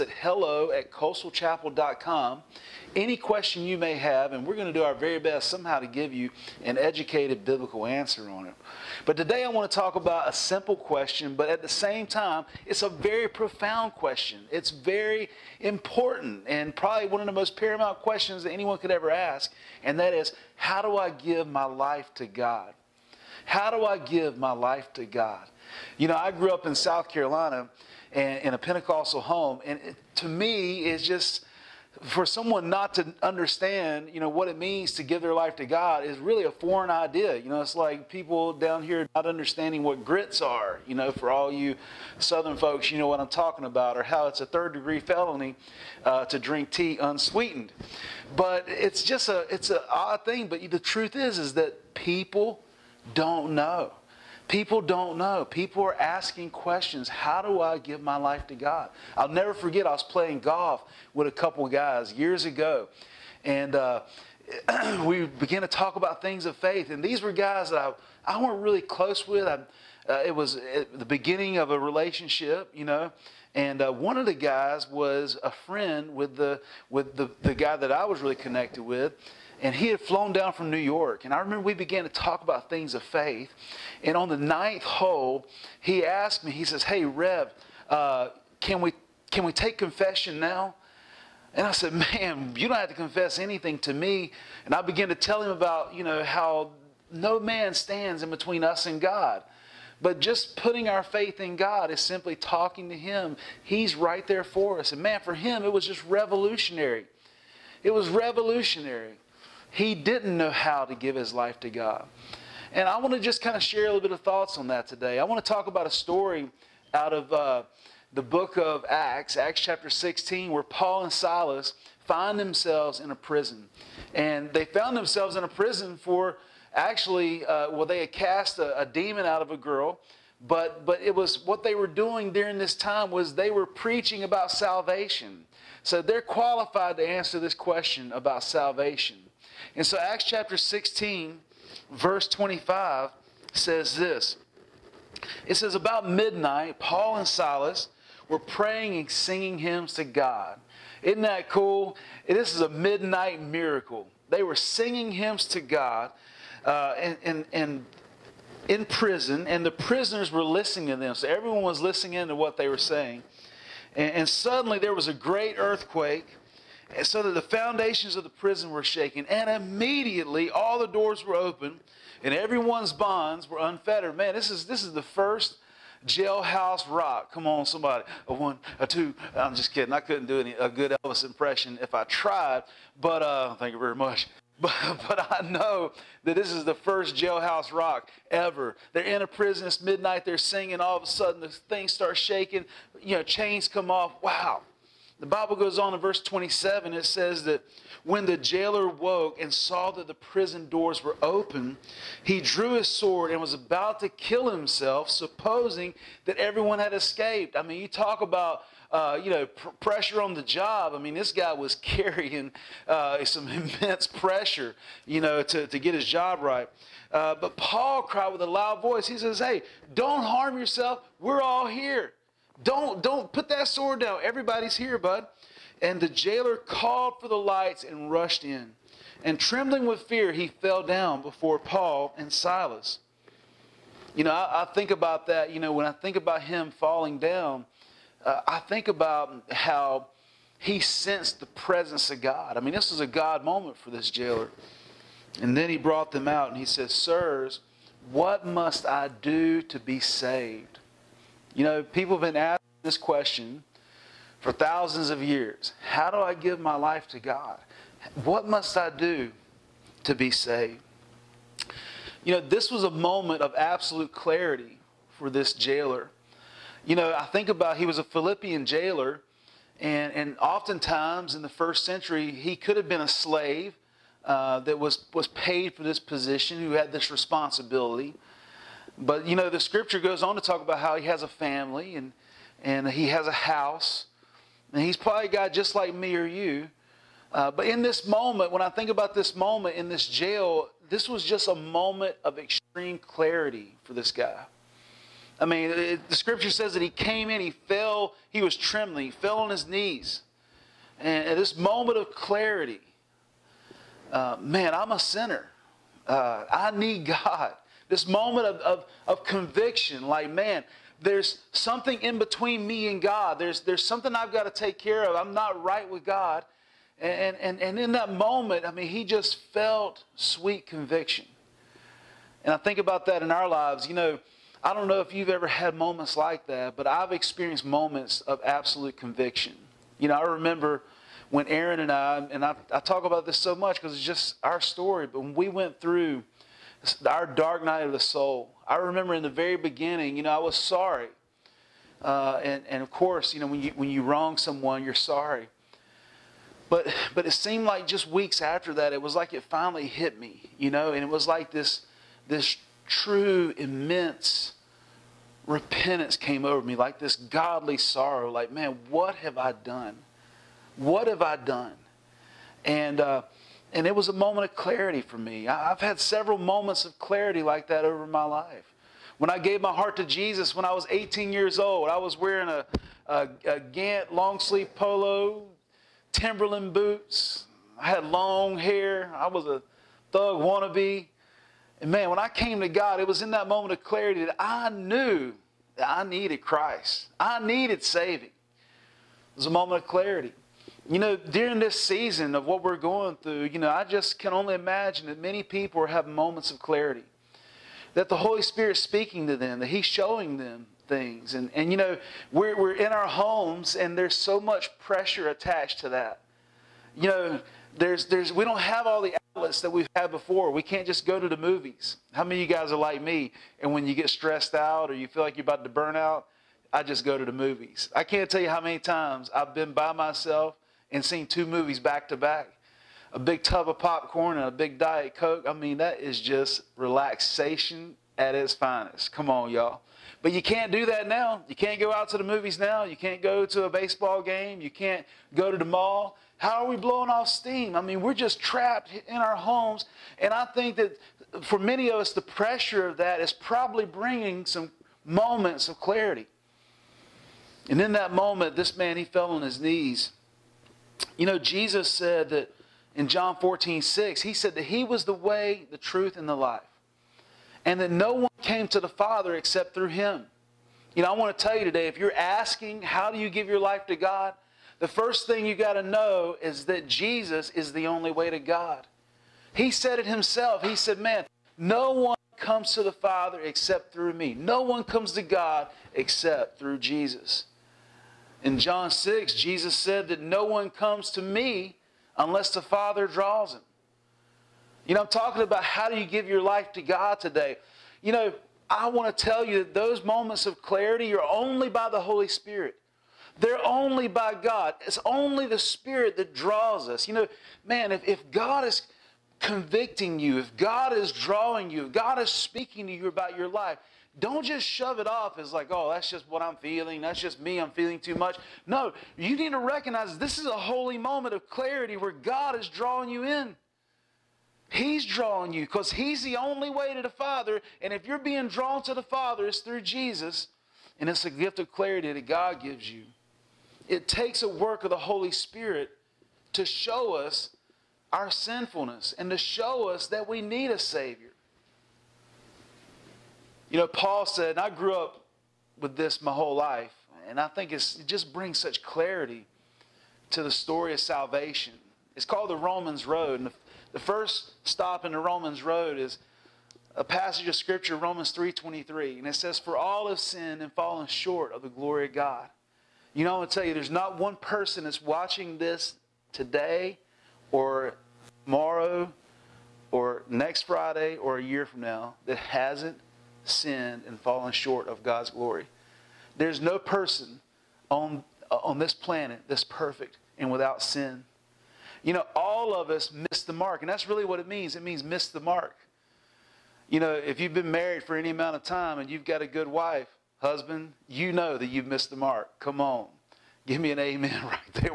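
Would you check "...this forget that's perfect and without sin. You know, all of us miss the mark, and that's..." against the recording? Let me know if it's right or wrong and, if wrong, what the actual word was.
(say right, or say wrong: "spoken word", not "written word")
wrong: "planet", not "forget".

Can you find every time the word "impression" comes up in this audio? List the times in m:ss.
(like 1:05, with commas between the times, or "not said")
3:01.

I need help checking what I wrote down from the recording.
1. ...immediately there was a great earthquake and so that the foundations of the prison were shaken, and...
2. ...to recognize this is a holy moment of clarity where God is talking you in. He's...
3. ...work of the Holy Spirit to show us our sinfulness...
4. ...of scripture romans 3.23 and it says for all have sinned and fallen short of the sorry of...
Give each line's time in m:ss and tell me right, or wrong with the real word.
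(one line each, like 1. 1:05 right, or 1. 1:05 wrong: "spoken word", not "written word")
1. 2:44 wrong: "suddenly", not "immediately"
2. 8:29 wrong: "drawing", not "talking"
3. 8:44 right
4. 9:07 wrong: "glory", not "sorry".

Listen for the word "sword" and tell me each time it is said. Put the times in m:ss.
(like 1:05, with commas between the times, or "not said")
3:22, 3:43.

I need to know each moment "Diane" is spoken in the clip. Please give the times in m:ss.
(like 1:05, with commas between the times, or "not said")
not said.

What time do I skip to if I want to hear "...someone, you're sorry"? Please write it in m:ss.
5:44.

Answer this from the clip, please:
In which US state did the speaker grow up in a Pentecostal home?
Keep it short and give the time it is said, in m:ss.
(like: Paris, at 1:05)
South Carolina, at 0:26.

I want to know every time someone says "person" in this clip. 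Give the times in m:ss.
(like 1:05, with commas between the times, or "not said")
9:14, 9:26.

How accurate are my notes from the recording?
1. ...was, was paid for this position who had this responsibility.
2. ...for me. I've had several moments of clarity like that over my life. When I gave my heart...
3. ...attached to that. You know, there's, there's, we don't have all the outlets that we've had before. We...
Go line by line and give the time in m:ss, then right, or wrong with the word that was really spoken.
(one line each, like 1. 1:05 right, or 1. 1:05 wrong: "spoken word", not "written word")
1. 4:34 right
2. 6:04 right
3. 6:45 right.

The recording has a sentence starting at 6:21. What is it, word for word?
And man, when I came to God, it was in that moment of clarity that I knew that I needed Christ.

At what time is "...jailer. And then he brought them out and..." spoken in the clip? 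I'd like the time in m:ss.
4:04.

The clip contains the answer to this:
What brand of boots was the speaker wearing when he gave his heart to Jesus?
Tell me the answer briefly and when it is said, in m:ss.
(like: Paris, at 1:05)
Timberland, at 6:16.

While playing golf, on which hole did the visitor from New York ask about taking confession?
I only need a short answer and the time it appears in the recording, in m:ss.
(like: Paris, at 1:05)
ninth, at 1:24.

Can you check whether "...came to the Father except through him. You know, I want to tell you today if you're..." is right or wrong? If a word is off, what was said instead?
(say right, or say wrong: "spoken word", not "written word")
right.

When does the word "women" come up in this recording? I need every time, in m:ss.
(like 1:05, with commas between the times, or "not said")
not said.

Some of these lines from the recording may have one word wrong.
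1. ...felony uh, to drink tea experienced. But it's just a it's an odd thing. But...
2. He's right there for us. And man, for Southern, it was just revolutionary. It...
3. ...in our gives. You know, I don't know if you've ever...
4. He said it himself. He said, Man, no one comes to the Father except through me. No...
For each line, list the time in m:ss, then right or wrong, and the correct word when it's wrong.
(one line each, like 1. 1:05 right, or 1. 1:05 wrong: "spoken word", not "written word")
1. 0:44 wrong: "unsweetened", not "experienced"
2. 1:43 wrong: "Him", not "Southern"
3. 5:23 wrong: "lives", not "gives"
4. 7:49 right.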